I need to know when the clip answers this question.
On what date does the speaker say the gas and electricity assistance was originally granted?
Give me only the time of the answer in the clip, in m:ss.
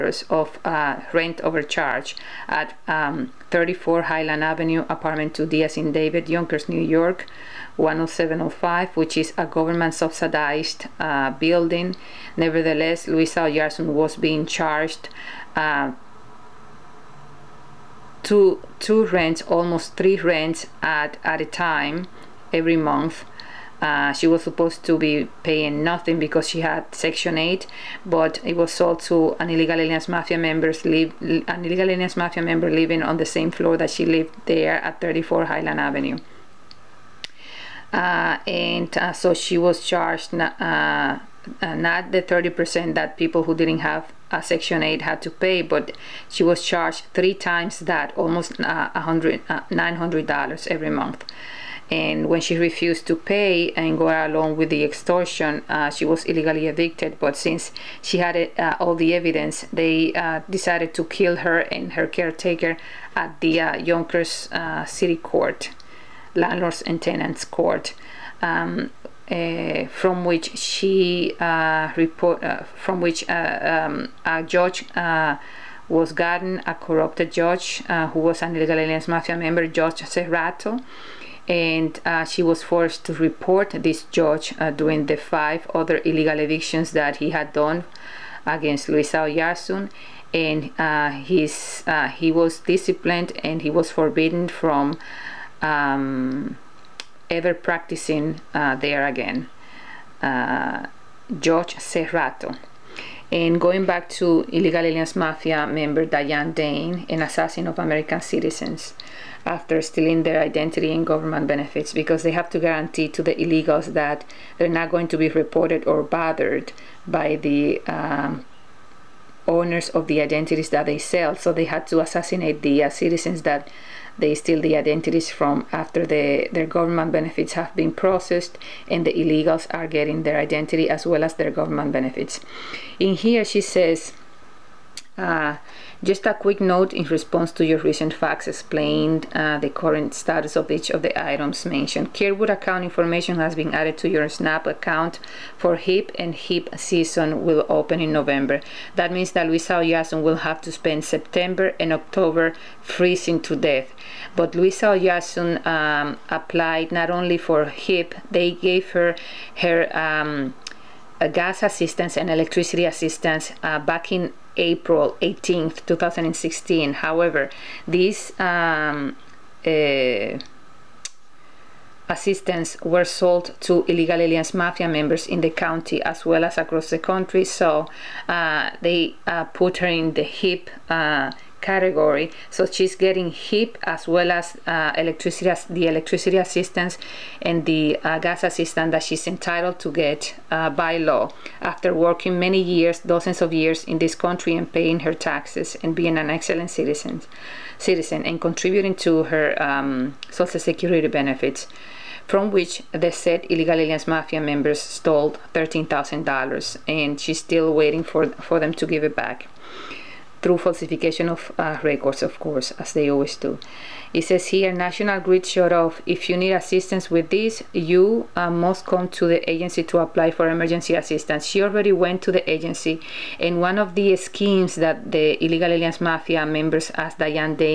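2:44.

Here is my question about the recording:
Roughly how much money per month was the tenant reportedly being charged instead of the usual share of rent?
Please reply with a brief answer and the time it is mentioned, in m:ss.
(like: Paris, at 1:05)
$900, at 0:48.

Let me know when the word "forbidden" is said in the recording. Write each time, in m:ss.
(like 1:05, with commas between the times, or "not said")
1:33.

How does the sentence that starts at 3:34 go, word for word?
It says here, National Grid shut off.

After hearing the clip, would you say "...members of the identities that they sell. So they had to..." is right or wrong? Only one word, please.
wrong.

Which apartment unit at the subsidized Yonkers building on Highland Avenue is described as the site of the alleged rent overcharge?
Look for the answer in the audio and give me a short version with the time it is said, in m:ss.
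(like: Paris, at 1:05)
2D, at 0:05.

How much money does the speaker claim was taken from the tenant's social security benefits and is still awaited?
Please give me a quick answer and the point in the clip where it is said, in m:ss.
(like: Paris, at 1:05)
$13,000, at 3:25.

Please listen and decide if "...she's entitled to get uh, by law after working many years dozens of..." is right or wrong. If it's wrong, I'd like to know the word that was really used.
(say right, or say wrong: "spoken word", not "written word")
right.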